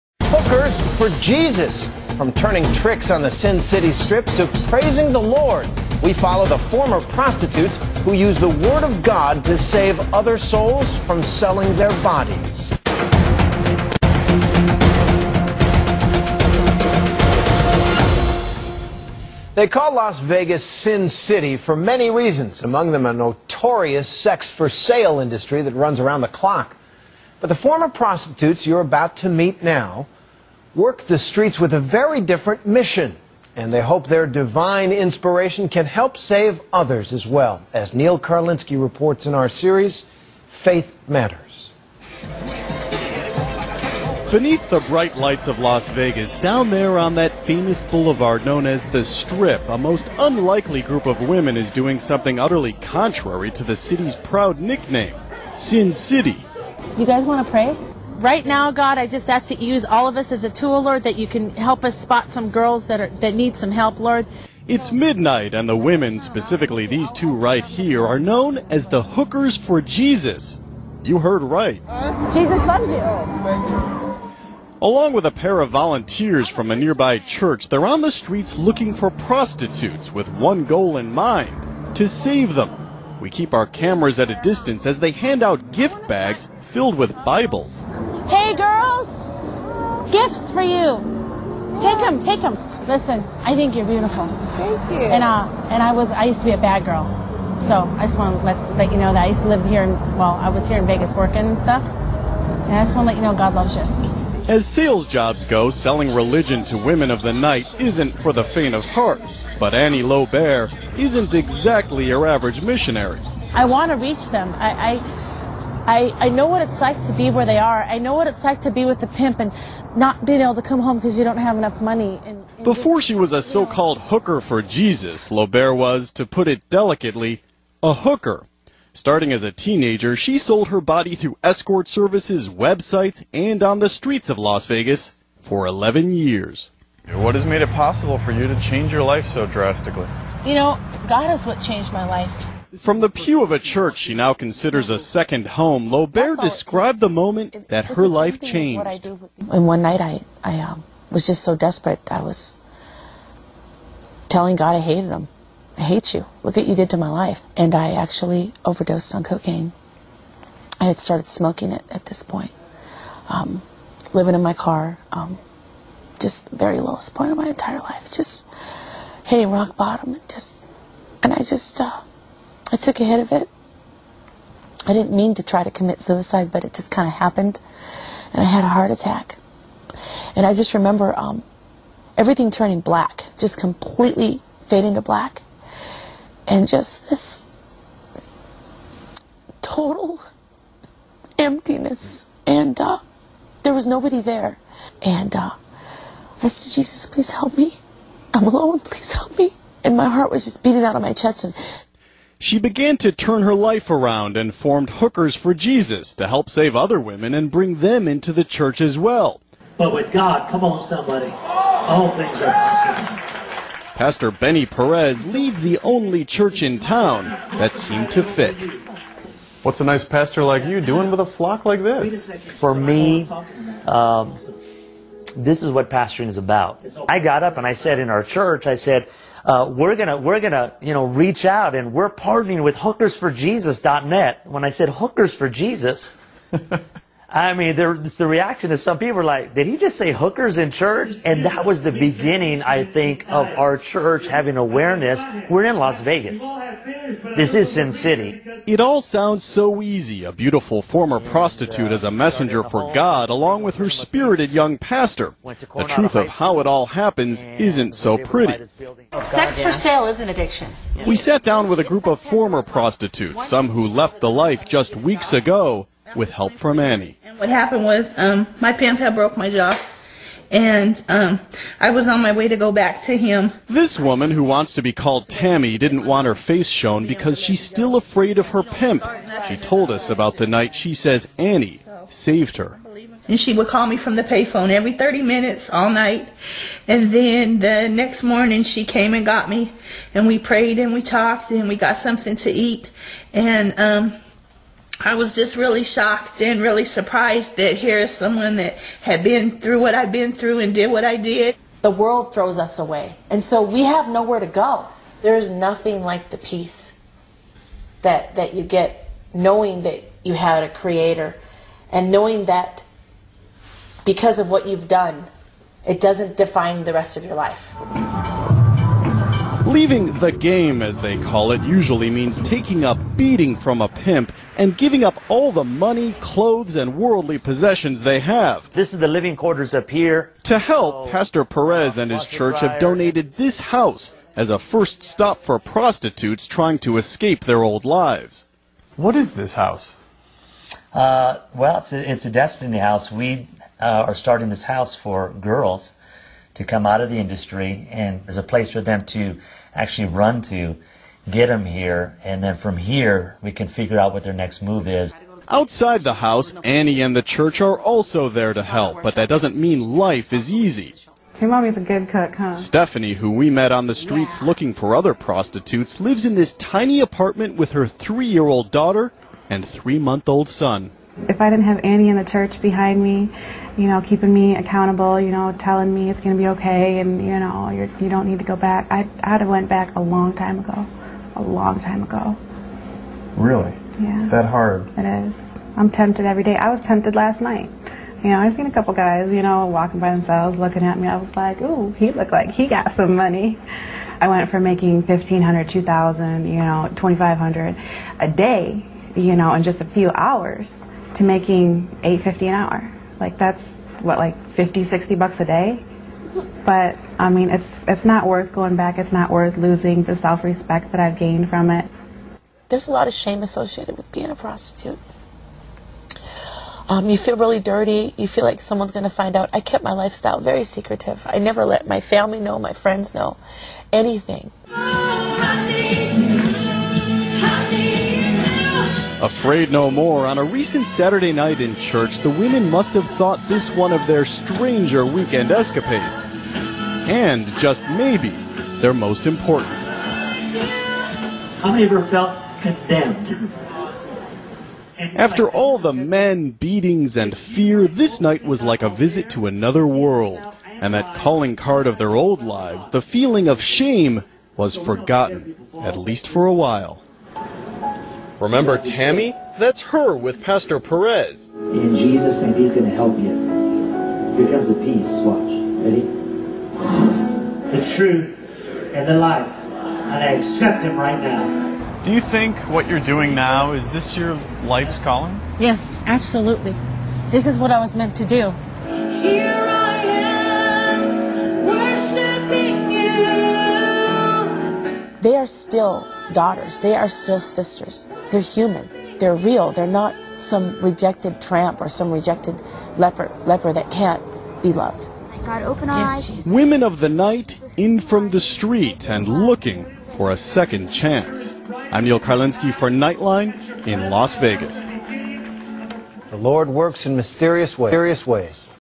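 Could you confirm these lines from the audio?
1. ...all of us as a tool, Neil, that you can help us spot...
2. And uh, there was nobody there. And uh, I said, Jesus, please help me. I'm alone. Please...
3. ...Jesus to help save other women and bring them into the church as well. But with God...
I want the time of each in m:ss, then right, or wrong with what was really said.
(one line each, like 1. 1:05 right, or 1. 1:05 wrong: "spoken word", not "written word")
1. 0:59 wrong: "Lord", not "Neil"
2. 3:12 right
3. 3:25 right.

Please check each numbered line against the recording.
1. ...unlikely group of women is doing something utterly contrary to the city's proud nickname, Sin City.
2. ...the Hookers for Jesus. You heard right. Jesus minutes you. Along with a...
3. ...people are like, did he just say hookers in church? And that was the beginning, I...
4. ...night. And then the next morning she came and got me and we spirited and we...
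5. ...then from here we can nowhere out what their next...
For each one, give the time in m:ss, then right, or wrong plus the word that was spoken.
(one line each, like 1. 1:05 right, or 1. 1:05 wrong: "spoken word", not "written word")
1. 0:50 right
2. 1:08 wrong: "loves", not "minutes"
3. 3:58 right
4. 4:45 wrong: "prayed", not "spirited"
5. 5:52 wrong: "figure", not "nowhere".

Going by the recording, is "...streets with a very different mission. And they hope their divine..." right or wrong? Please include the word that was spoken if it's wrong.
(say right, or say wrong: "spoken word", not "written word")
right.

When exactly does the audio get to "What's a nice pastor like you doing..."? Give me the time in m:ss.
3:39.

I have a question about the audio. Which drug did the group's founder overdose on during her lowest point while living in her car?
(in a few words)
cocaine.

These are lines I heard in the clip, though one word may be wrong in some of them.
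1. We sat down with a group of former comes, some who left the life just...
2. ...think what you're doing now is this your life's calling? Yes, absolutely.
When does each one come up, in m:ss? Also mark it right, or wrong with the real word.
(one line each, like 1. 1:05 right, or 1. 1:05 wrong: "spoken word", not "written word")
1. 4:21 wrong: "prostitutes", not "comes"
2. 7:52 right.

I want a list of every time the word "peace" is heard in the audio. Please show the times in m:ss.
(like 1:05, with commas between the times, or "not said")
5:06, 7:44.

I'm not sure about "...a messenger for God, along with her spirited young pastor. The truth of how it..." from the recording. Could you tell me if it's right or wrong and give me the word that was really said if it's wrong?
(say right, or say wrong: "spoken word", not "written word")
right.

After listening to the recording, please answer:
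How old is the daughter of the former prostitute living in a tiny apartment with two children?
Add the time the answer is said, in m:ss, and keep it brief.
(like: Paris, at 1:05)
3 years old, at 6:07.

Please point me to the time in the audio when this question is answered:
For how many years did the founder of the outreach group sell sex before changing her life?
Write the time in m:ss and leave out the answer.
2:15.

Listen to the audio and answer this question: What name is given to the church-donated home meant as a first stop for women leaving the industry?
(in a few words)
destiny house.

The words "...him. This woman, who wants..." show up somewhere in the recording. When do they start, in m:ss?
4:33.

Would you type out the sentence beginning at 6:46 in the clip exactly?
But I mean, it's it's not worth going back.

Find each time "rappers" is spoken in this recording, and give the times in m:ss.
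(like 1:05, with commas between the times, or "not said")
not said.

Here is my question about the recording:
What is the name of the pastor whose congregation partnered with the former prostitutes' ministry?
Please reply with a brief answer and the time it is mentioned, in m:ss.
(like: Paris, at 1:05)
Benny Perez, at 3:34.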